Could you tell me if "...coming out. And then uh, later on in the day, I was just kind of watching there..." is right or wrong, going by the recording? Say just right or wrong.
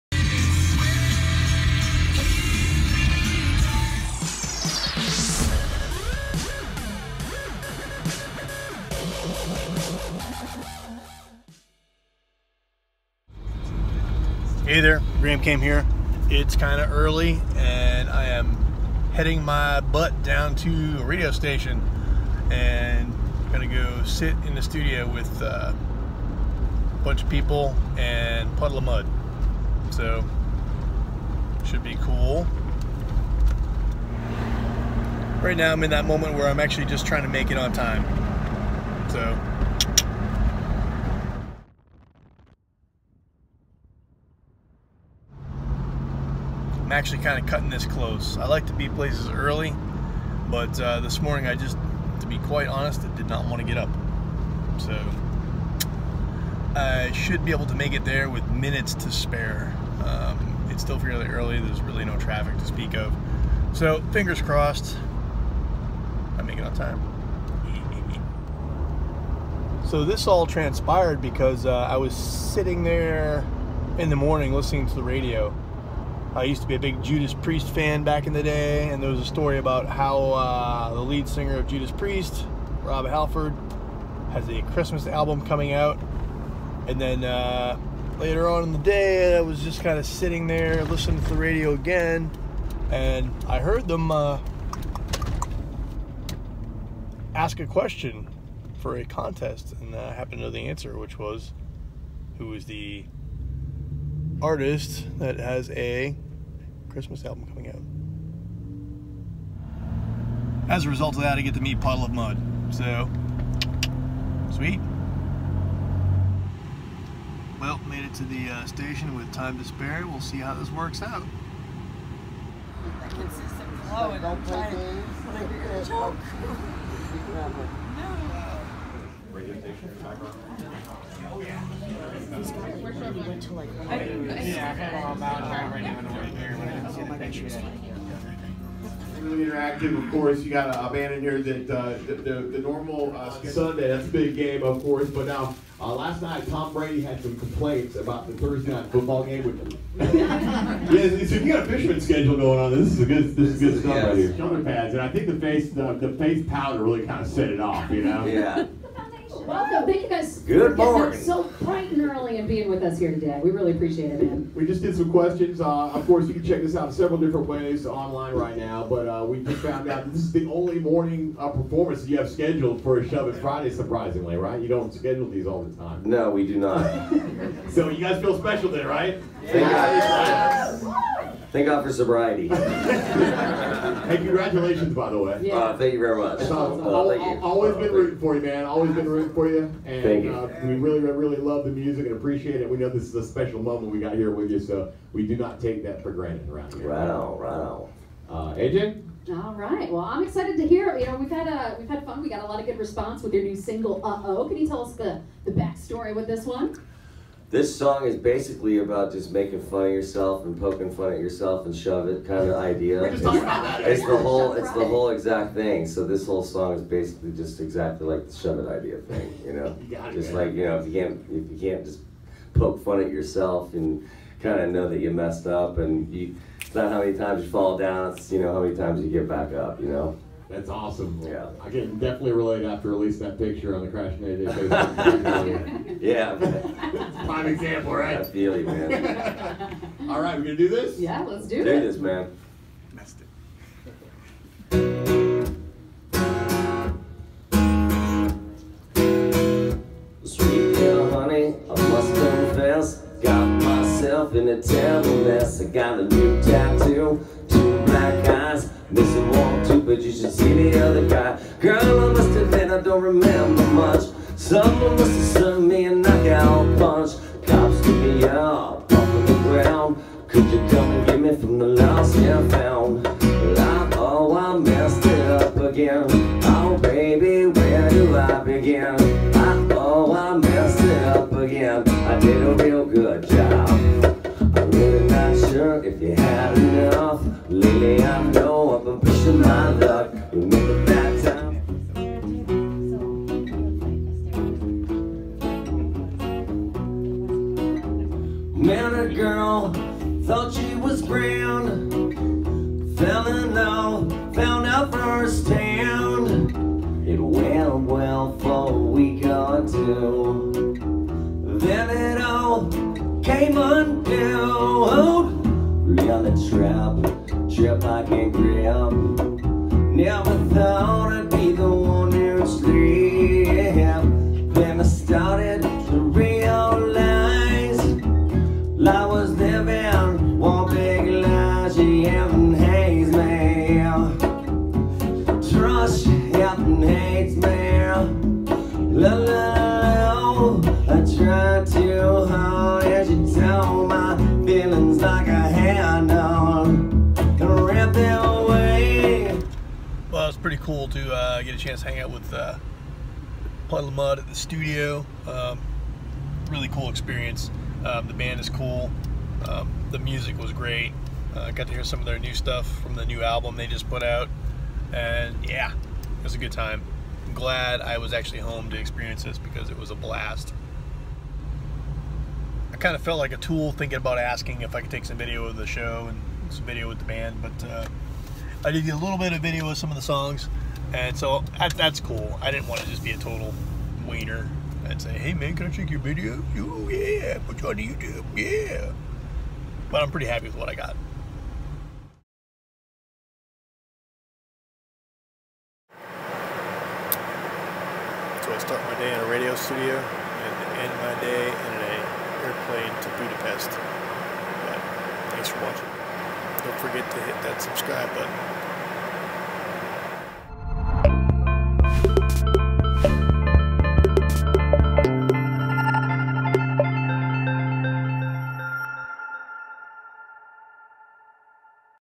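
wrong.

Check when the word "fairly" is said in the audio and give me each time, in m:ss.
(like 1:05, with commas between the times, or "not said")
1:00.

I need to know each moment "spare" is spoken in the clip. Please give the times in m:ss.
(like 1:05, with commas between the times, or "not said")
0:59, 1:59.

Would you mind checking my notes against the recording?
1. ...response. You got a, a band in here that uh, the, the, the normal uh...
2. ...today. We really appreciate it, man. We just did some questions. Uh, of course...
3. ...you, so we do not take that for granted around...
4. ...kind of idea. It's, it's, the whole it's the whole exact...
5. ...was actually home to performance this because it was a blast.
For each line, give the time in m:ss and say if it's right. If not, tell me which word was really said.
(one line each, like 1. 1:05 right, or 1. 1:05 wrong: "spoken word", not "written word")
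1. 2:20 wrong: "course", not "response"
2. 2:43 right
3. 3:14 right
4. 3:32 right
5. 6:07 wrong: "experience", not "performance".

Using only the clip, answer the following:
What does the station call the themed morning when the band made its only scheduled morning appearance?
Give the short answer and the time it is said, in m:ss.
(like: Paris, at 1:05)
Shove It Friday, at 2:53.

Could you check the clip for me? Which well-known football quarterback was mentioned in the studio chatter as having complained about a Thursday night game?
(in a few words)
Tom Brady.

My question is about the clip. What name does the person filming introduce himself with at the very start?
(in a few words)
Graham Cam.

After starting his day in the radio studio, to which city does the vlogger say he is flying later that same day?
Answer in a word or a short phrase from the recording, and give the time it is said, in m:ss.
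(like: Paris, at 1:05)
Budapest, at 6:43.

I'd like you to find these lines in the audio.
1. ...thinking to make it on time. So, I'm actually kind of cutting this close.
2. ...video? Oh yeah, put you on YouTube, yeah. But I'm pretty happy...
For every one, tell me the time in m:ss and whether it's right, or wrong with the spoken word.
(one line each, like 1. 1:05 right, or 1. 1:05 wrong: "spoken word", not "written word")
1. 0:37 wrong: "trying", not "thinking"
2. 6:25 right.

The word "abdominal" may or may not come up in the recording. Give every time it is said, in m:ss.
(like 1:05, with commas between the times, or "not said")
not said.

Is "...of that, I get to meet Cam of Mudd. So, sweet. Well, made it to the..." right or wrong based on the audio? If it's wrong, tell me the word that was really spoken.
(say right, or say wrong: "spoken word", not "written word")
wrong: "Puddle", not "Cam".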